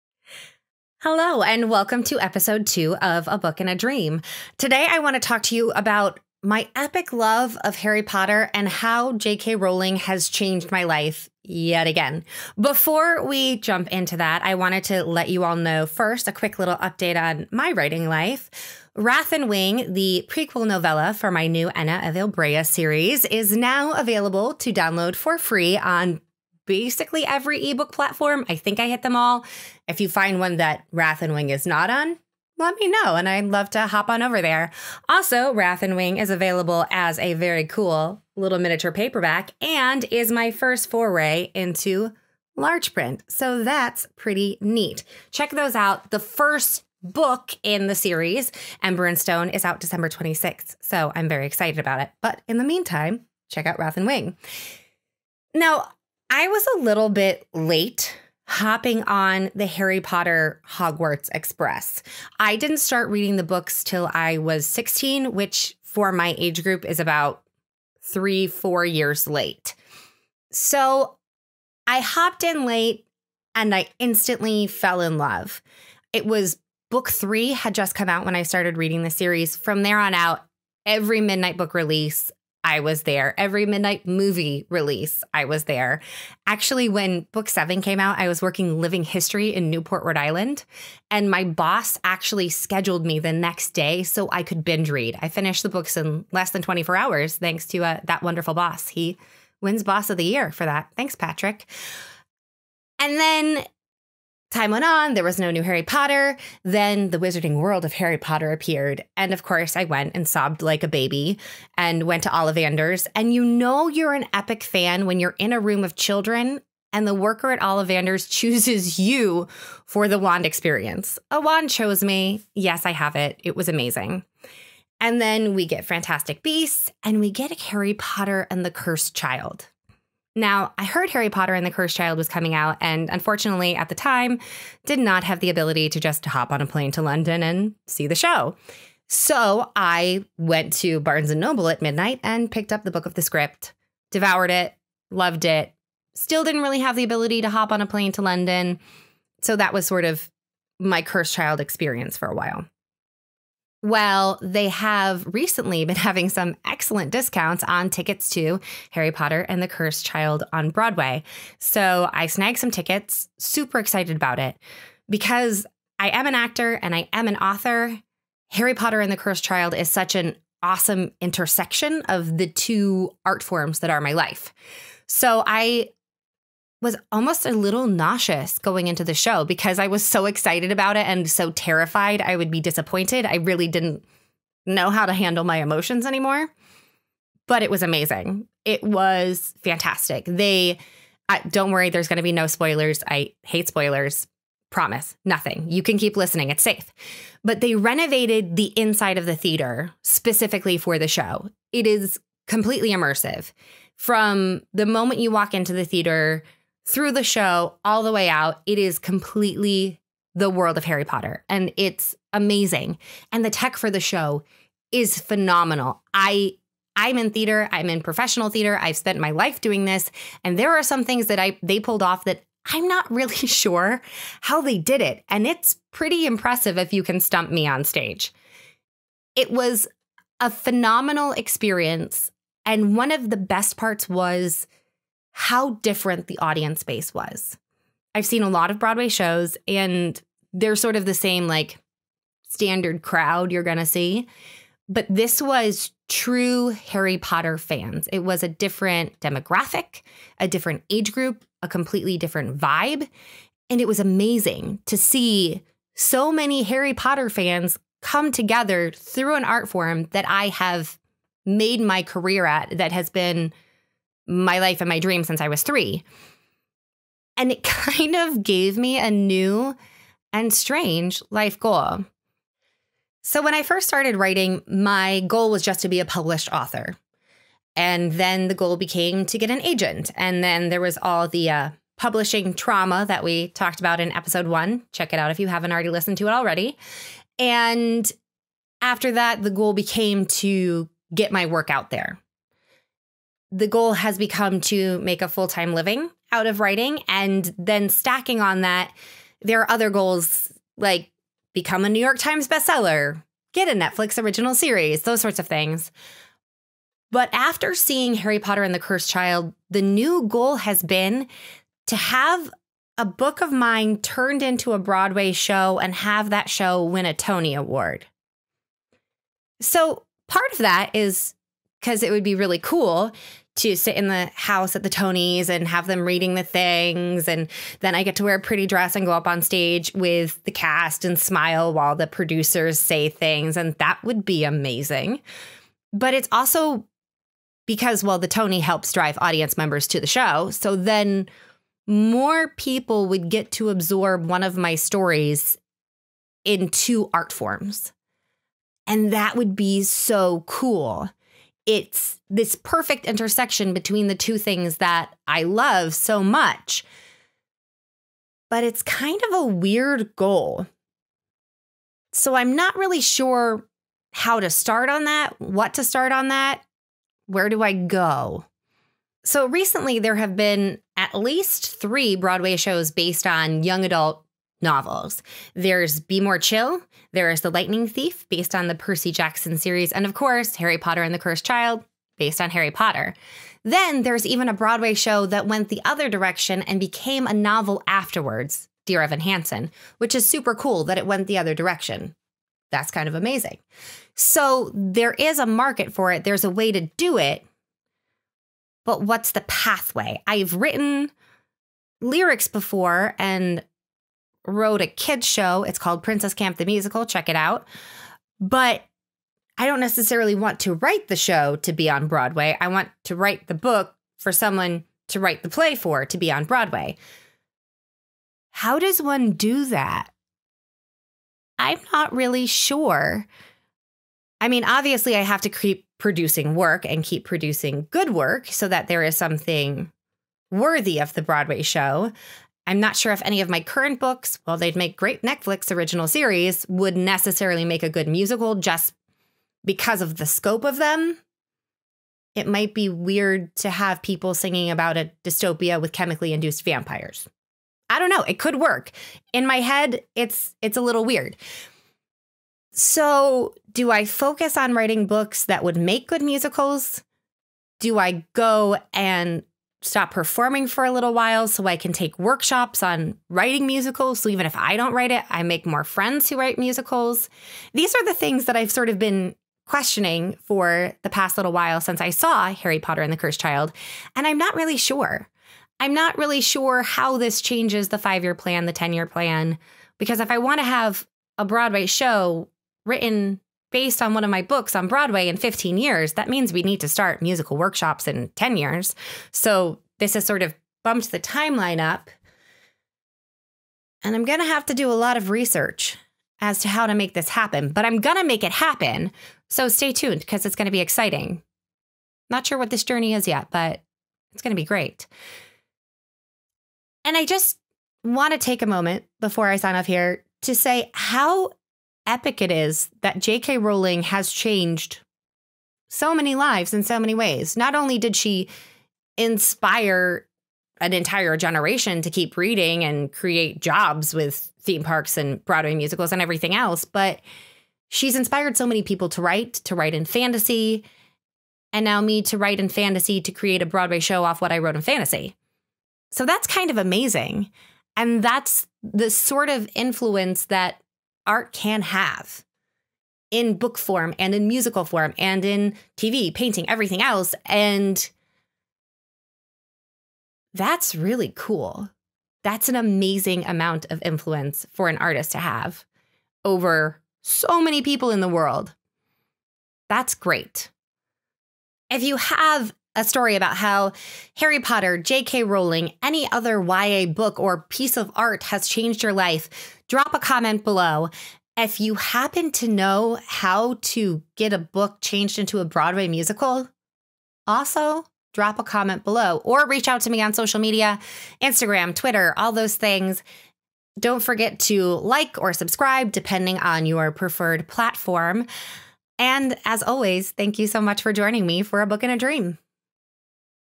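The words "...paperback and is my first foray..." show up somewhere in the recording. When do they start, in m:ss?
0:38.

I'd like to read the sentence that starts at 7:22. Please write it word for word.
It might be weird to have people singing about a dystopia with chemically induced vampires.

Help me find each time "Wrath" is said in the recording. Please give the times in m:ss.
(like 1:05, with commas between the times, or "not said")
0:18, 0:30, 0:35, 0:53.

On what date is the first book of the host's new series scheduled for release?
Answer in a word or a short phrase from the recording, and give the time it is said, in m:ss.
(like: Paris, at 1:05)
December 26th, at 0:49.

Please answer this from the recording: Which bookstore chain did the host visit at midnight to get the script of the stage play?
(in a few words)
Barnes and Noble.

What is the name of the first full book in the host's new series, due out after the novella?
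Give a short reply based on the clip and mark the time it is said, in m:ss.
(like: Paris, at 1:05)
Ember and Stone, at 0:48.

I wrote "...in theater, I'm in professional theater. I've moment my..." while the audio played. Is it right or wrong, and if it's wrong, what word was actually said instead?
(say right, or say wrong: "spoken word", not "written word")
wrong: "spent", not "moment".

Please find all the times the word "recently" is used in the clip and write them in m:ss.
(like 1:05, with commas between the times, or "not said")
2:35, 6:09.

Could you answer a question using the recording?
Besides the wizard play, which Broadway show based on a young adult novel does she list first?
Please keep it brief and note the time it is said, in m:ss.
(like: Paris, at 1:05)
Be More Chill, at 6:15.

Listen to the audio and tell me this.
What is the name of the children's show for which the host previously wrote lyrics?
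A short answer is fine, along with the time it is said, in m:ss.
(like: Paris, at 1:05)
Princess Camp the Musical, at 6:46.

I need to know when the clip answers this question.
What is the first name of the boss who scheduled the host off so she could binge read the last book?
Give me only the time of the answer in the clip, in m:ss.
1:41.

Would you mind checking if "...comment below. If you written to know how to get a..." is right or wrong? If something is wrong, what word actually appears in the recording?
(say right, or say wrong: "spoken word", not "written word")
wrong: "happen", not "written".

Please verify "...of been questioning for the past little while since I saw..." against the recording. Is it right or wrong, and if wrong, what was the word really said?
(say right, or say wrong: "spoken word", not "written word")
right.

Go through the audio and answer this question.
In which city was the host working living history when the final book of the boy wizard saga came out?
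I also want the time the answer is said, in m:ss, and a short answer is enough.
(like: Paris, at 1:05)
Newport, Rhode Island, at 1:29.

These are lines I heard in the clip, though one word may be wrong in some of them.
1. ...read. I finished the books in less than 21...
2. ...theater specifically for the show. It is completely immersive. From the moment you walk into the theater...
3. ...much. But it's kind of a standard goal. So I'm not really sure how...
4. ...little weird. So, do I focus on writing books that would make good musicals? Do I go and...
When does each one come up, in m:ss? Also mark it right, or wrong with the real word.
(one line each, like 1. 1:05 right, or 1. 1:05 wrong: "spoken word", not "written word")
1. 1:34 wrong: "24", not "21"
2. 3:19 right
3. 5:56 wrong: "weird", not "standard"
4. 7:30 right.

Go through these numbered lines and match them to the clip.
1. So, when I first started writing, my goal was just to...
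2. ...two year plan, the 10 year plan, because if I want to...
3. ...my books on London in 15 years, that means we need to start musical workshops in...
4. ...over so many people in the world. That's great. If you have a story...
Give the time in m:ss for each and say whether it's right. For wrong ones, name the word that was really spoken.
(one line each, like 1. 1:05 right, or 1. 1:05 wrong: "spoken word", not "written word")
1. 4:33 right
2. 7:57 wrong: "five", not "two"
3. 8:04 wrong: "Broadway", not "London"
4. 9:16 right.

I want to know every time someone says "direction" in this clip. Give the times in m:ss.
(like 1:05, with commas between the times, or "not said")
6:26, 6:31.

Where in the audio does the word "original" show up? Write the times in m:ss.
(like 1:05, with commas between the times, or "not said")
5:04, 7:15.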